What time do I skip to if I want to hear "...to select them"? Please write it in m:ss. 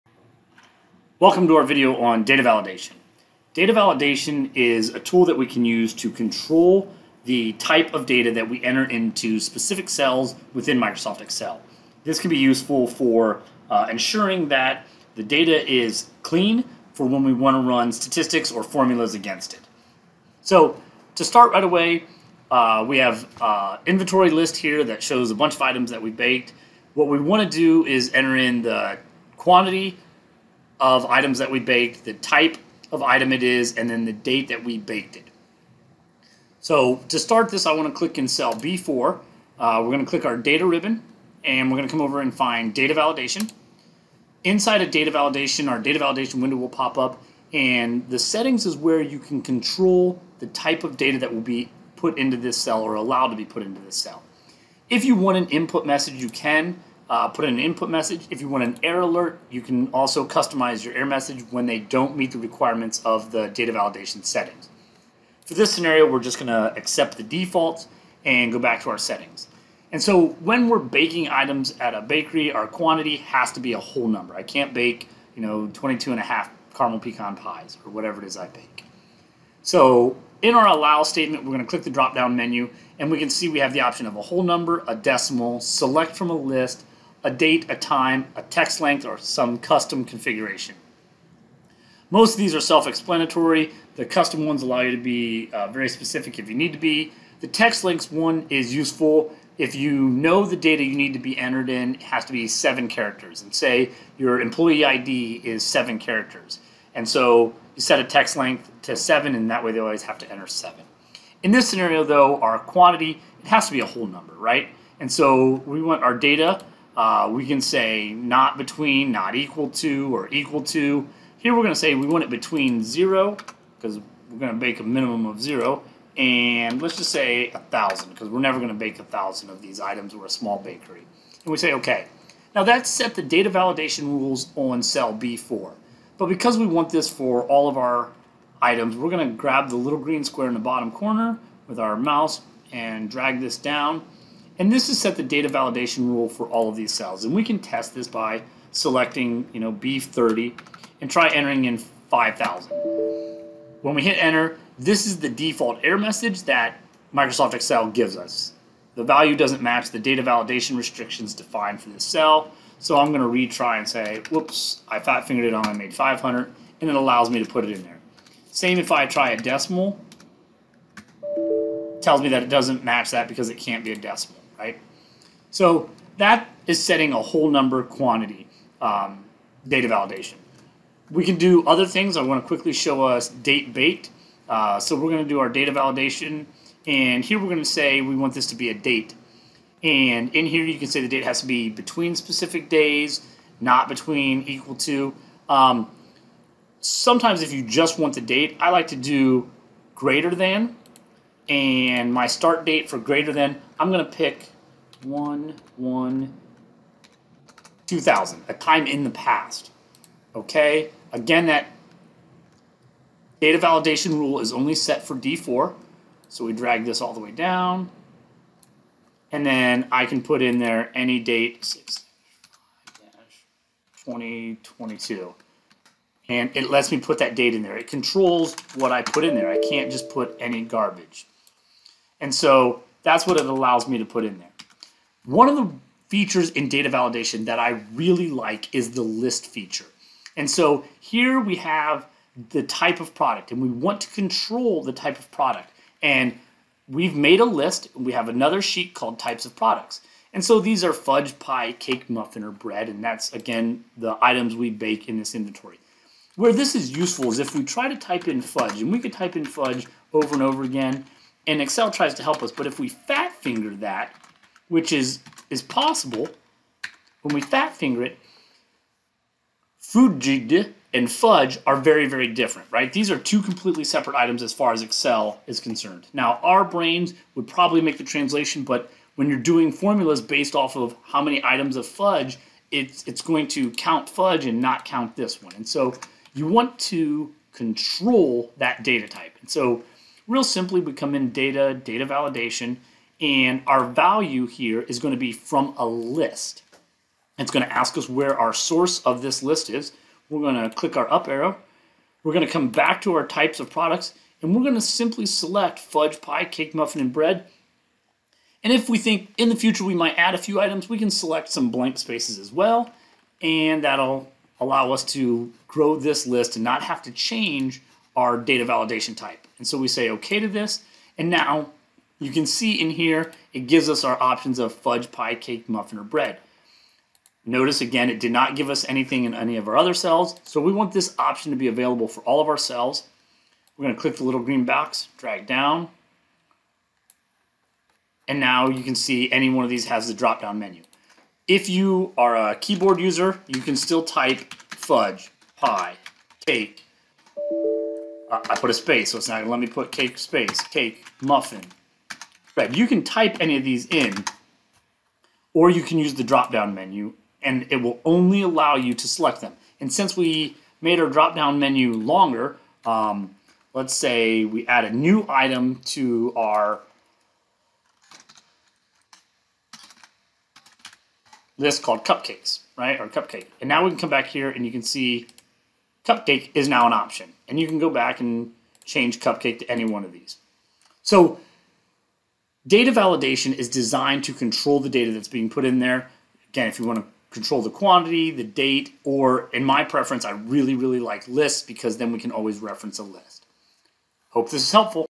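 5:58.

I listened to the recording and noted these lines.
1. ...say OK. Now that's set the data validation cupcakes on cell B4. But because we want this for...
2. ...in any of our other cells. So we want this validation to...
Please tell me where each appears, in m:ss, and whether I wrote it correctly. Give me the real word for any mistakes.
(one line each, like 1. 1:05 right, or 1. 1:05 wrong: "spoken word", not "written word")
1. 2:11 wrong: "rules", not "cupcakes"
2. 5:29 wrong: "option", not "validation".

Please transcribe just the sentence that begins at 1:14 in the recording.
I can't bake, you know, 22 and a half caramel pecan pies or whatever it is I bake.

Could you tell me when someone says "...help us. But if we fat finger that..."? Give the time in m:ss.
4:22.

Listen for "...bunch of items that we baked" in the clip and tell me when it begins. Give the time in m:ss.
0:25.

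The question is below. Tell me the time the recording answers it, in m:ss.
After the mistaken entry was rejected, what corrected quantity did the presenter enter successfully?
2:45.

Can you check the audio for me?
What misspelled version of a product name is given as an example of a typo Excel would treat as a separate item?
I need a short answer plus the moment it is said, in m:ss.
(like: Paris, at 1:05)
fudged, at 4:29.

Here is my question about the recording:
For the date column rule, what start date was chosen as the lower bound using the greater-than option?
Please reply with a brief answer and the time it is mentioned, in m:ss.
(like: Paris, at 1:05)
1/1/2000, at 3:25.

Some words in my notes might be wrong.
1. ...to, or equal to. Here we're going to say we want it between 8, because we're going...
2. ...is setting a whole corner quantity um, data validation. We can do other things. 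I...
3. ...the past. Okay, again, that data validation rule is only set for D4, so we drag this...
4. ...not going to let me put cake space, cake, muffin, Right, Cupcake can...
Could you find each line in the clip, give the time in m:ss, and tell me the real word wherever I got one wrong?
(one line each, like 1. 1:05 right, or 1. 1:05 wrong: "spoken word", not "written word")
1. 1:59 wrong: "0", not "8"
2. 2:56 wrong: "number", not "corner"
3. 3:29 right
4. 5:49 wrong: "You", not "Cupcake".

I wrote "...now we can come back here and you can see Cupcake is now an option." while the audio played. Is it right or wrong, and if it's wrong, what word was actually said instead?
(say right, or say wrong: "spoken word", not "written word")
right.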